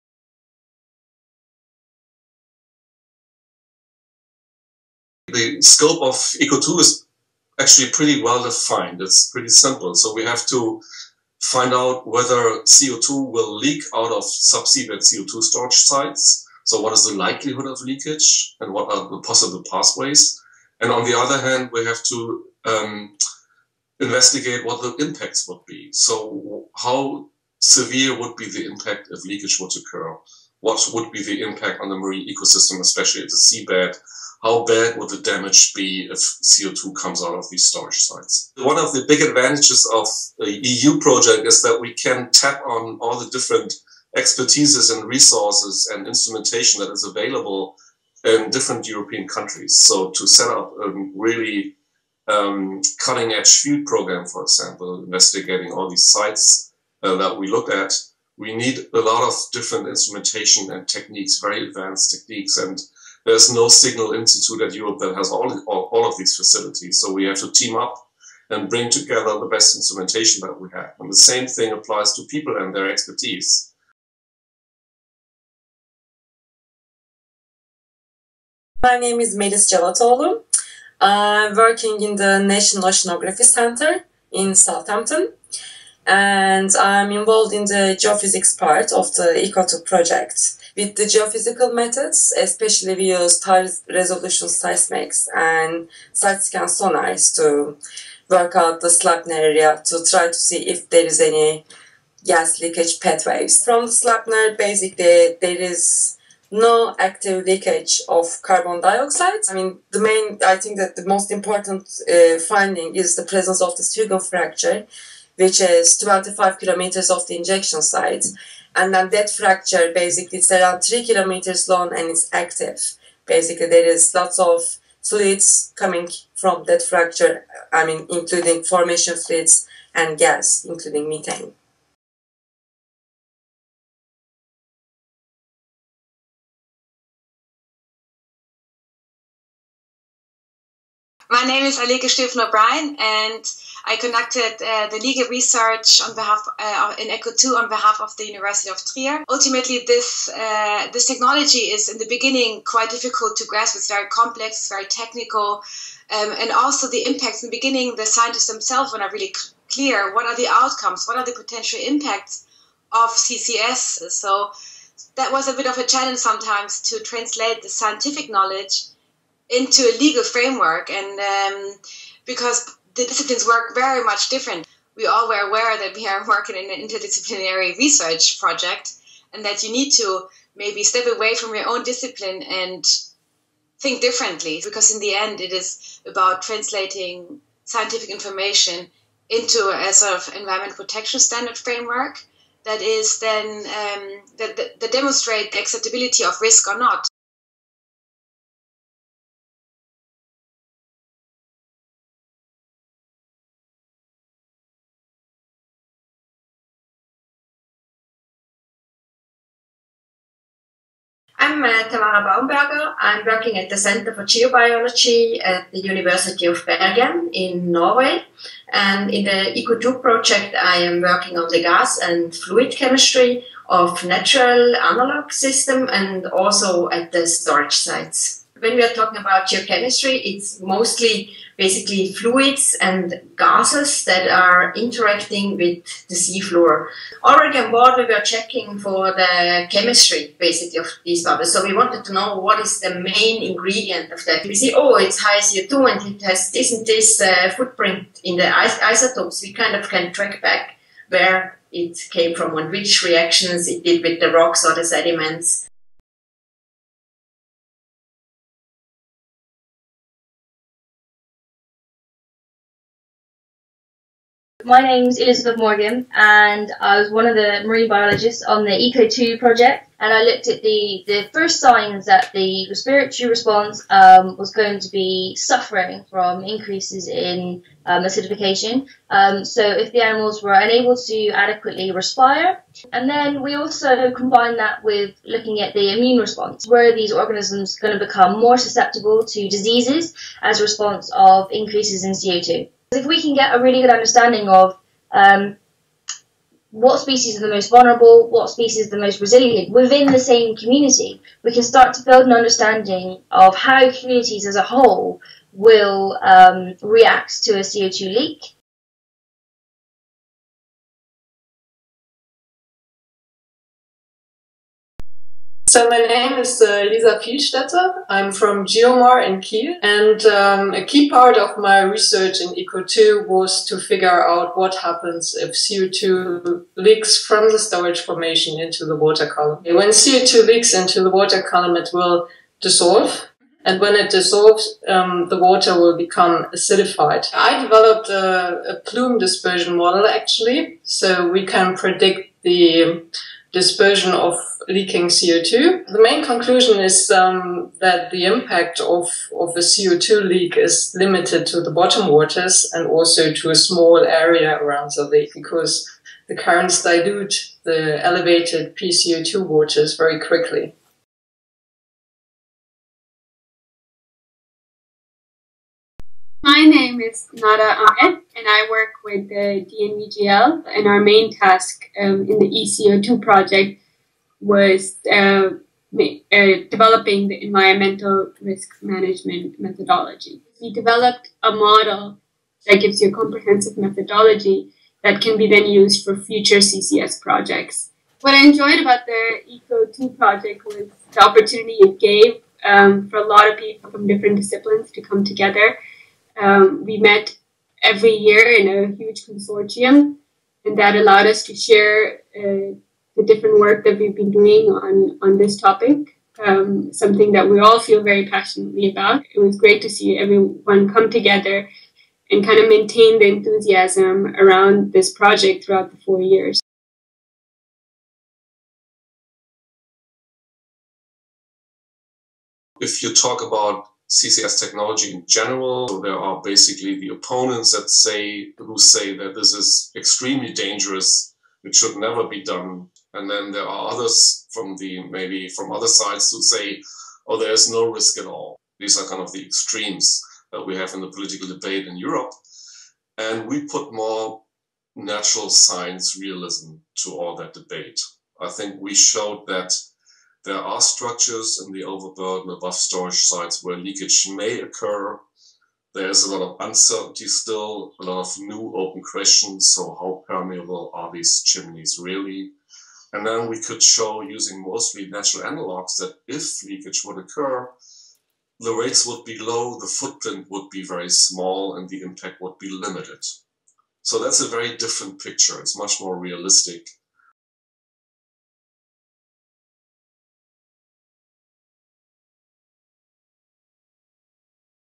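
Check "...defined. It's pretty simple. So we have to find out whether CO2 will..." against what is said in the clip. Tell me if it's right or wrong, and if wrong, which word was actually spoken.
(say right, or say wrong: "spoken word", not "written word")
right.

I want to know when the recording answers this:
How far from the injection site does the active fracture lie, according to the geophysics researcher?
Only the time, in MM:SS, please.
01:55.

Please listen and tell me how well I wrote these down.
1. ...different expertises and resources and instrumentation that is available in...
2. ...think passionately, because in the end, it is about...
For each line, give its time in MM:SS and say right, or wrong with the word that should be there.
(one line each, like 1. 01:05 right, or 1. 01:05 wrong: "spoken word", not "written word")
1. 00:43 right
2. 03:03 wrong: "differently", not "passionately".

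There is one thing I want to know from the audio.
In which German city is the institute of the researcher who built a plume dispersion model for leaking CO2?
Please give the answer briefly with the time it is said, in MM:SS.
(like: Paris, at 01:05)
Kiel, at 05:19.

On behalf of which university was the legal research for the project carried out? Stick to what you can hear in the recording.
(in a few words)
University of Trier.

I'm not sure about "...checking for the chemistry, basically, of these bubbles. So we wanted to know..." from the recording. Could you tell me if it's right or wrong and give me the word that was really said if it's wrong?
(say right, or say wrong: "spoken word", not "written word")
right.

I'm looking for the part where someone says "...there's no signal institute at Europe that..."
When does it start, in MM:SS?
01:03.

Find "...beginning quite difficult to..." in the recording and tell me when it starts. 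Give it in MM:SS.
02:32.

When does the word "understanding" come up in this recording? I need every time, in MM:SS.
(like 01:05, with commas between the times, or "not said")
04:53, 05:02.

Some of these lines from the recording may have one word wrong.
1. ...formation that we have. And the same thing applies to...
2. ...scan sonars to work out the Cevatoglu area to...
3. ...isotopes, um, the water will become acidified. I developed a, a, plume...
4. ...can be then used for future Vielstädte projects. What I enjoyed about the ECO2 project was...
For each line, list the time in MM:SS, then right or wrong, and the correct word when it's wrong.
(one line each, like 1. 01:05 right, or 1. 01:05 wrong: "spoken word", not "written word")
1. 01:09 wrong: "instrumentation", not "formation"
2. 01:36 wrong: "Sleipner", not "Cevatoglu"
3. 05:34 wrong: "dissolves", not "isotopes"
4. 06:25 wrong: "CCS", not "Vielstädte".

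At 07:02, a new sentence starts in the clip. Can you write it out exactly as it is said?
If you talk about CCS technology in general.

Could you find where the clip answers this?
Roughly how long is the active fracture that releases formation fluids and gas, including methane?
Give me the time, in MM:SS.
02:00.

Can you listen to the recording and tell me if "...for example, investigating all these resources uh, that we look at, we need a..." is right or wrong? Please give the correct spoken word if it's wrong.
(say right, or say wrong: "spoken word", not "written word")
wrong: "sites", not "resources".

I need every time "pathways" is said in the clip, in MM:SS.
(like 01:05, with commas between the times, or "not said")
00:19, 01:43.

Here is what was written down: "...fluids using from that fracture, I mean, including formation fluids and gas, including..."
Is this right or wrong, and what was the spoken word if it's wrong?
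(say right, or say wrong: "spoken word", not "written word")
wrong: "coming", not "using".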